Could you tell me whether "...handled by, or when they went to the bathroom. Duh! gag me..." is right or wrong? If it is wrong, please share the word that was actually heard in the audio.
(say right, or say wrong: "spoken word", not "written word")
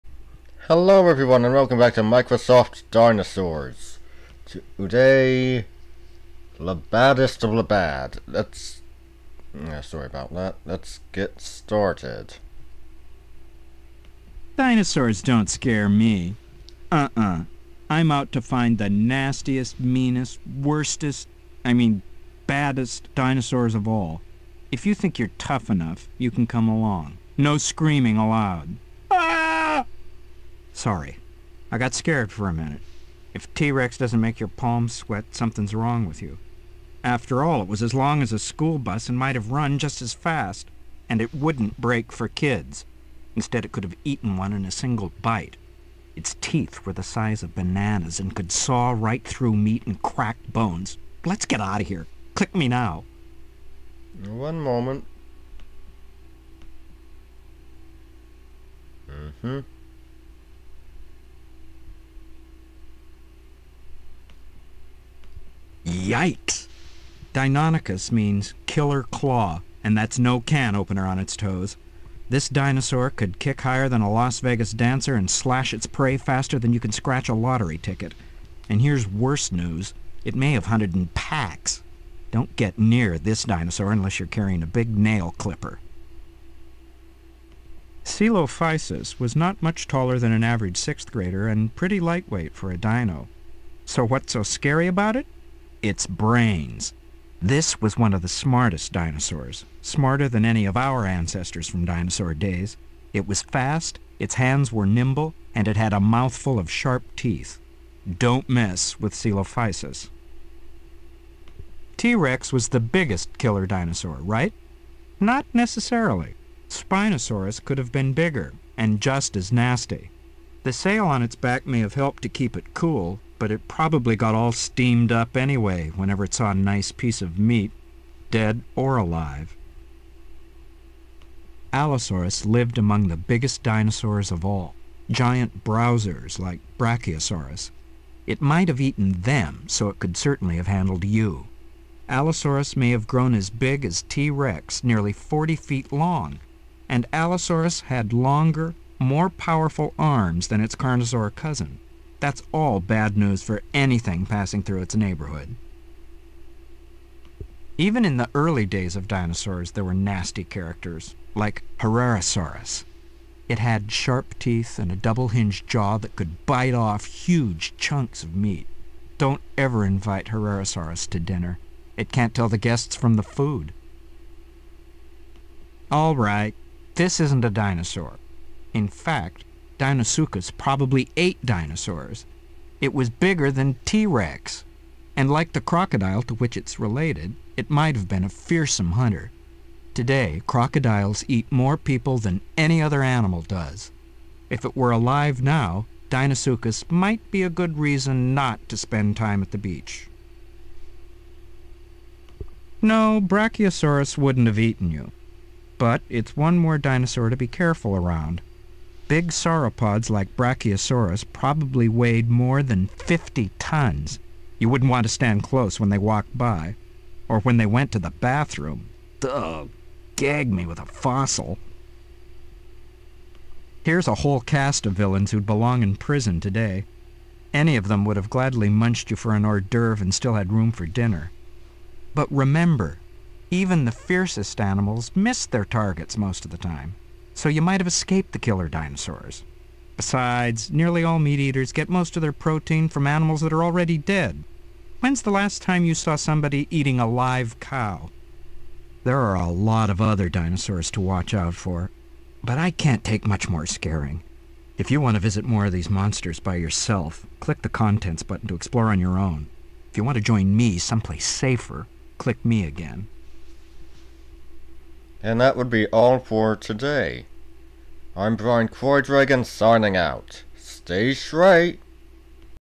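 wrong: "walked", not "handled".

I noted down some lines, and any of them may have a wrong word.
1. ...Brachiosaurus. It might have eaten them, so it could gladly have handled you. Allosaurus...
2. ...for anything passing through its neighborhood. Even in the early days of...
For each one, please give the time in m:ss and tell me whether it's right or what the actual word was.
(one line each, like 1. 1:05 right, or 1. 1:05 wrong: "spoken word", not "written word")
1. 2:16 wrong: "certainly", not "gladly"
2. 2:33 right.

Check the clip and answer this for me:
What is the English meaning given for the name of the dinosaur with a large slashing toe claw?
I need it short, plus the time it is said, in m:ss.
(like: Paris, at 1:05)
killer claw, at 1:08.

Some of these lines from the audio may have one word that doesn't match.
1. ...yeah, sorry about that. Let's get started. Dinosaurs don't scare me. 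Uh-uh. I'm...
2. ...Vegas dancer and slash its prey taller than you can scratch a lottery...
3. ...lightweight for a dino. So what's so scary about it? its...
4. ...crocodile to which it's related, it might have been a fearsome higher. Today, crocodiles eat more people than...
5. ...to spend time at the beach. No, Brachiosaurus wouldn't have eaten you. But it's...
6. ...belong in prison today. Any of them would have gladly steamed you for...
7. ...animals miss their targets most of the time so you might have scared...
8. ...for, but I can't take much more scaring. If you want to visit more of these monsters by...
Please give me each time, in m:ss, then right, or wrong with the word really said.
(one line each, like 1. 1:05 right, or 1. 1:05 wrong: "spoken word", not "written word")
1. 0:09 right
2. 1:14 wrong: "faster", not "taller"
3. 1:32 right
4. 3:05 wrong: "hunter", not "higher"
5. 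3:18 right
6. 3:45 wrong: "munched", not "steamed"
7. 3:54 wrong: "escaped", not "scared"
8. 4:11 right.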